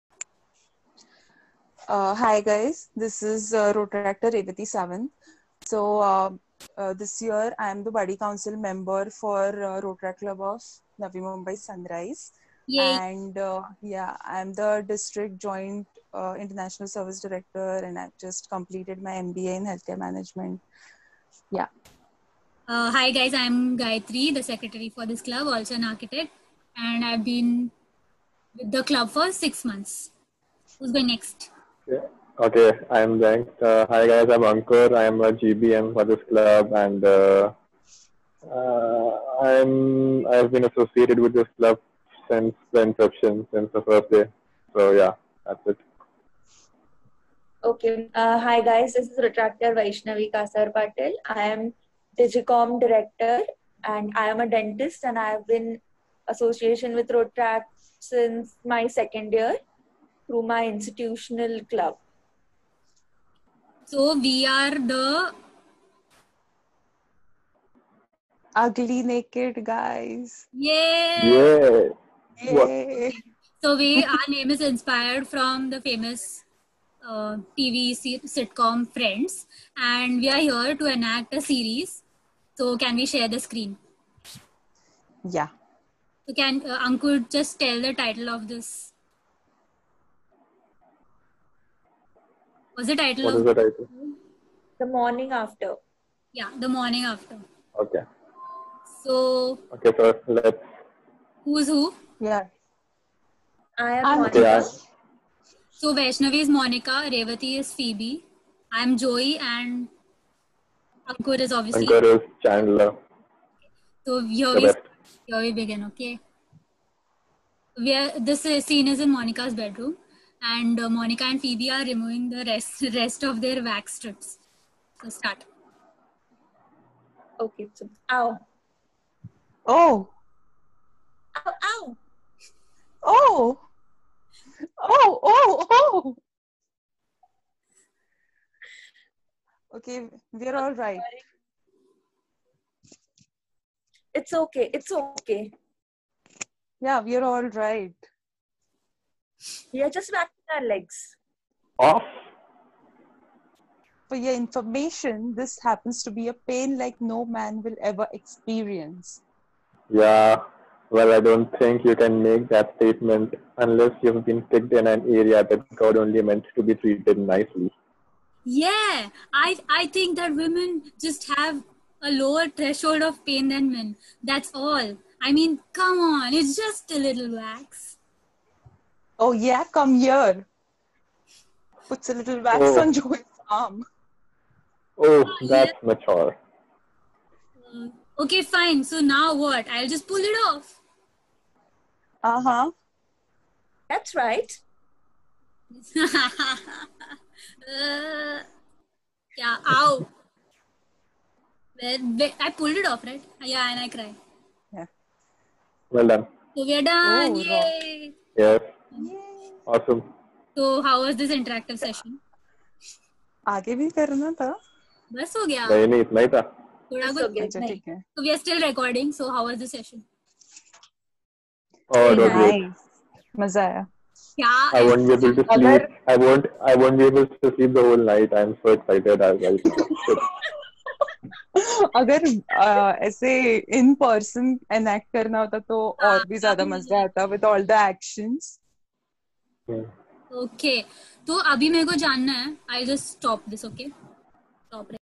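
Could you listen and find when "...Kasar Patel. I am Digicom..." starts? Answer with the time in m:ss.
0:50.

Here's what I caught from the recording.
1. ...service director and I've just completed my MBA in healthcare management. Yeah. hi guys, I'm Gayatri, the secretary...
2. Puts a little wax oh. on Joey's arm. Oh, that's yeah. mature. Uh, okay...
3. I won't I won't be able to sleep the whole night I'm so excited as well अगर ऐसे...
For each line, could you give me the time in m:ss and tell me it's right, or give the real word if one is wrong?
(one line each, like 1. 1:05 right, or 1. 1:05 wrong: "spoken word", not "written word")
1. 0:16 right
2. 3:01 right
3. 3:46 right.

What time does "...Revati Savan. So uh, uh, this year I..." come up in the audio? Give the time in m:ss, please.
0:04.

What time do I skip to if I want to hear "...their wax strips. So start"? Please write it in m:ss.
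2:03.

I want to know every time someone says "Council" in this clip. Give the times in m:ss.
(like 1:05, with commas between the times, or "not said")
0:08.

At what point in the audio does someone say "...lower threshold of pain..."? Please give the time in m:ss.
2:52.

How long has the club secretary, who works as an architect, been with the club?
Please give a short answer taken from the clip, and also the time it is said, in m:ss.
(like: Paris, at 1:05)
six months, at 0:29.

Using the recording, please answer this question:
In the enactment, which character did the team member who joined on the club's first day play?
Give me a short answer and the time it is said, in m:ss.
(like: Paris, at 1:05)
Chandler, at 1:52.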